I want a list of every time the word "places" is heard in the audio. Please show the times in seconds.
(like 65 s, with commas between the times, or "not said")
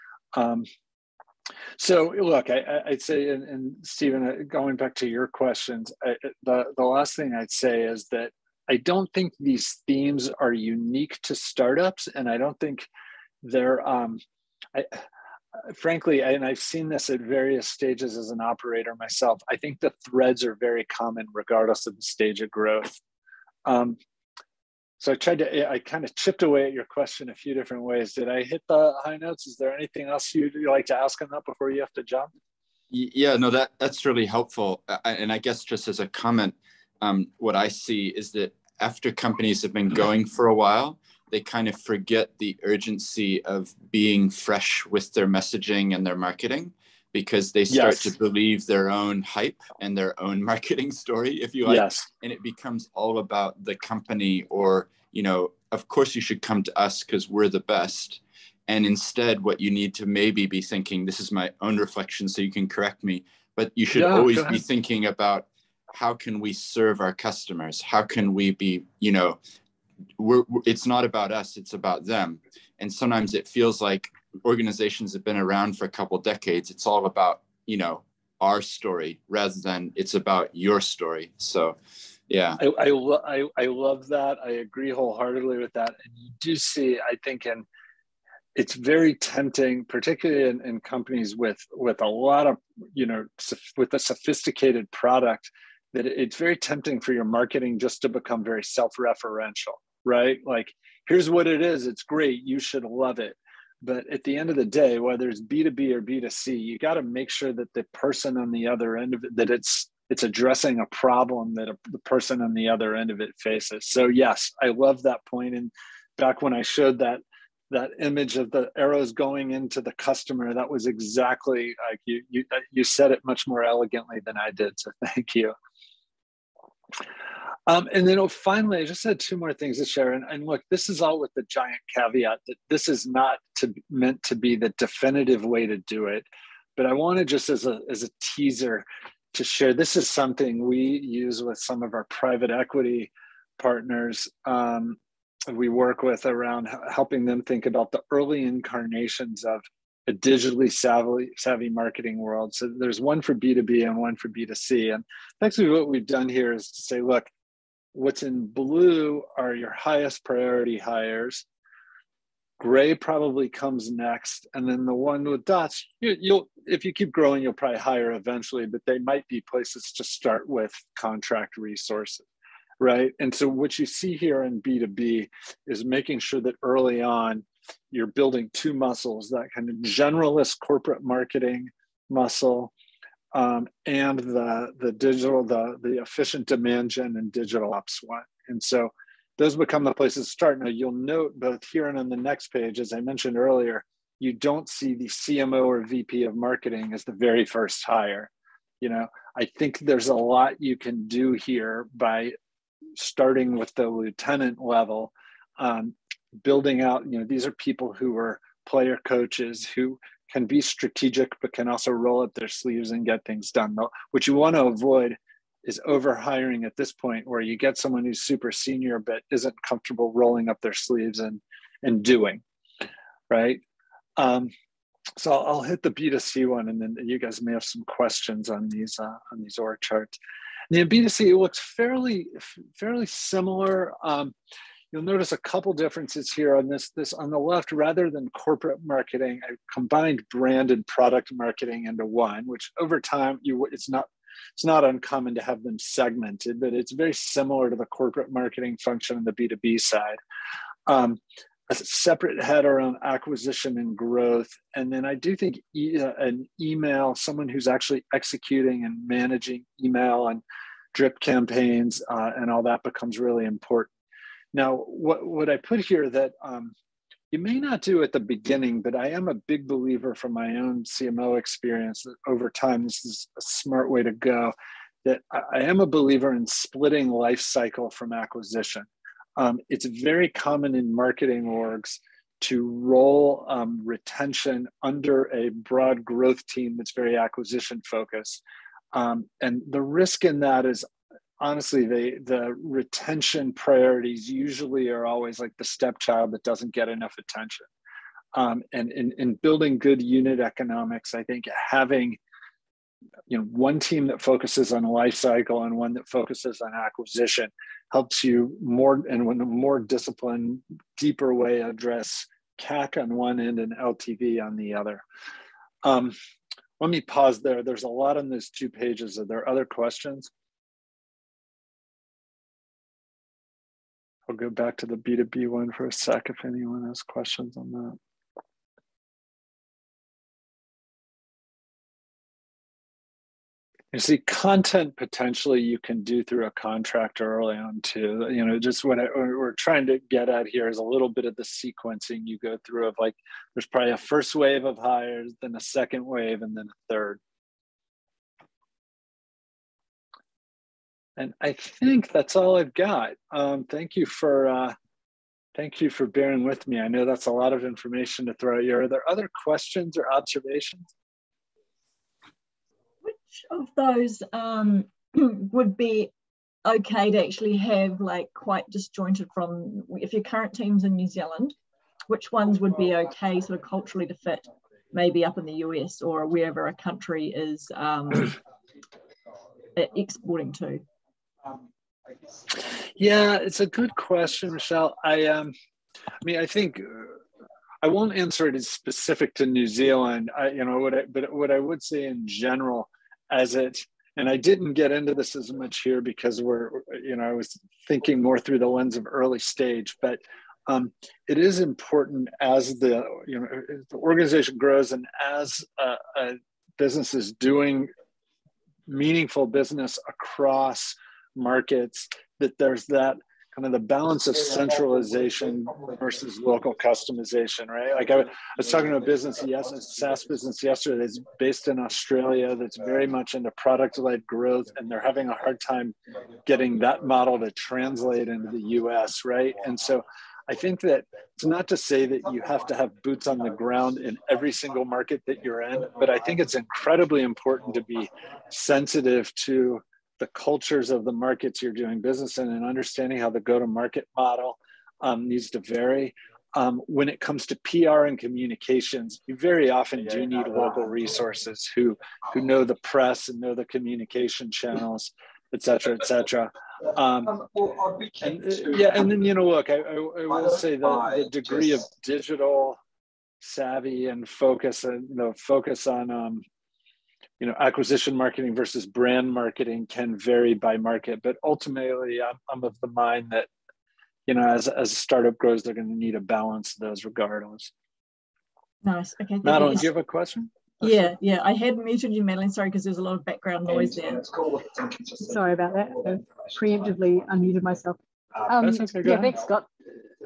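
169 s, 189 s.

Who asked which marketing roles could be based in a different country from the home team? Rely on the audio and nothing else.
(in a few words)
Michelle.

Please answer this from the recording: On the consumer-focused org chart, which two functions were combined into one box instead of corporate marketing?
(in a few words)
brand and product marketing.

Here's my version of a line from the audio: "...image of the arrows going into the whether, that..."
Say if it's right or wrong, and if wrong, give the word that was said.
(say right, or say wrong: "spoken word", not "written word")
wrong: "customer", not "whether".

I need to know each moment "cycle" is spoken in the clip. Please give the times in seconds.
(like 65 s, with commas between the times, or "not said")
277 s, 305 s.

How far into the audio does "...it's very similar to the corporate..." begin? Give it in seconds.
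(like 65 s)
246 s.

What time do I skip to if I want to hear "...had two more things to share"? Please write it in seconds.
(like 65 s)
129 s.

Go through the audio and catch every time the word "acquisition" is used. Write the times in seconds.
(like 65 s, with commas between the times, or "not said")
253 s, 278 s, 287 s, 306 s, 467 s.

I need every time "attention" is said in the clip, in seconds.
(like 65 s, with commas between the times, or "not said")
297 s.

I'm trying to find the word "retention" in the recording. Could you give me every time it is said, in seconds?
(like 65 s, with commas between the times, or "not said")
283 s, 292 s.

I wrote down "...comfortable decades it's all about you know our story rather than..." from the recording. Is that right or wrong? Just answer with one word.
wrong.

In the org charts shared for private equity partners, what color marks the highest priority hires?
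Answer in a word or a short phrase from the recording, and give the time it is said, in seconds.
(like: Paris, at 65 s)
blue, at 157 s.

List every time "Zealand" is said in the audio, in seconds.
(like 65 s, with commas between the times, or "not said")
371 s, 389 s.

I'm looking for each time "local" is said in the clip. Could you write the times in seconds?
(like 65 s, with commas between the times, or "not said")
416 s, 450 s.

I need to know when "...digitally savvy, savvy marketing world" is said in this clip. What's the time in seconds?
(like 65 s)
150 s.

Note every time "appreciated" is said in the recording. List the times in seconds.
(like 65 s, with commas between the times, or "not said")
not said.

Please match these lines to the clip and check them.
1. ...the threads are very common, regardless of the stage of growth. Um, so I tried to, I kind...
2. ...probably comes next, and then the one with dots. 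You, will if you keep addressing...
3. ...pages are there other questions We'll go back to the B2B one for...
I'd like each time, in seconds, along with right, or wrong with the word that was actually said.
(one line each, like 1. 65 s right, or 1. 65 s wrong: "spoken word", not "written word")
1. 19 s right
2. 162 s wrong: "growing", not "addressing"
3. 318 s right.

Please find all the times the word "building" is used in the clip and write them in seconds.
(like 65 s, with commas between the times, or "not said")
178 s, 206 s, 299 s.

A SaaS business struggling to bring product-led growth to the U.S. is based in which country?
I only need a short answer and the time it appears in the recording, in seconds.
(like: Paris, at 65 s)
Australia, at 421 s.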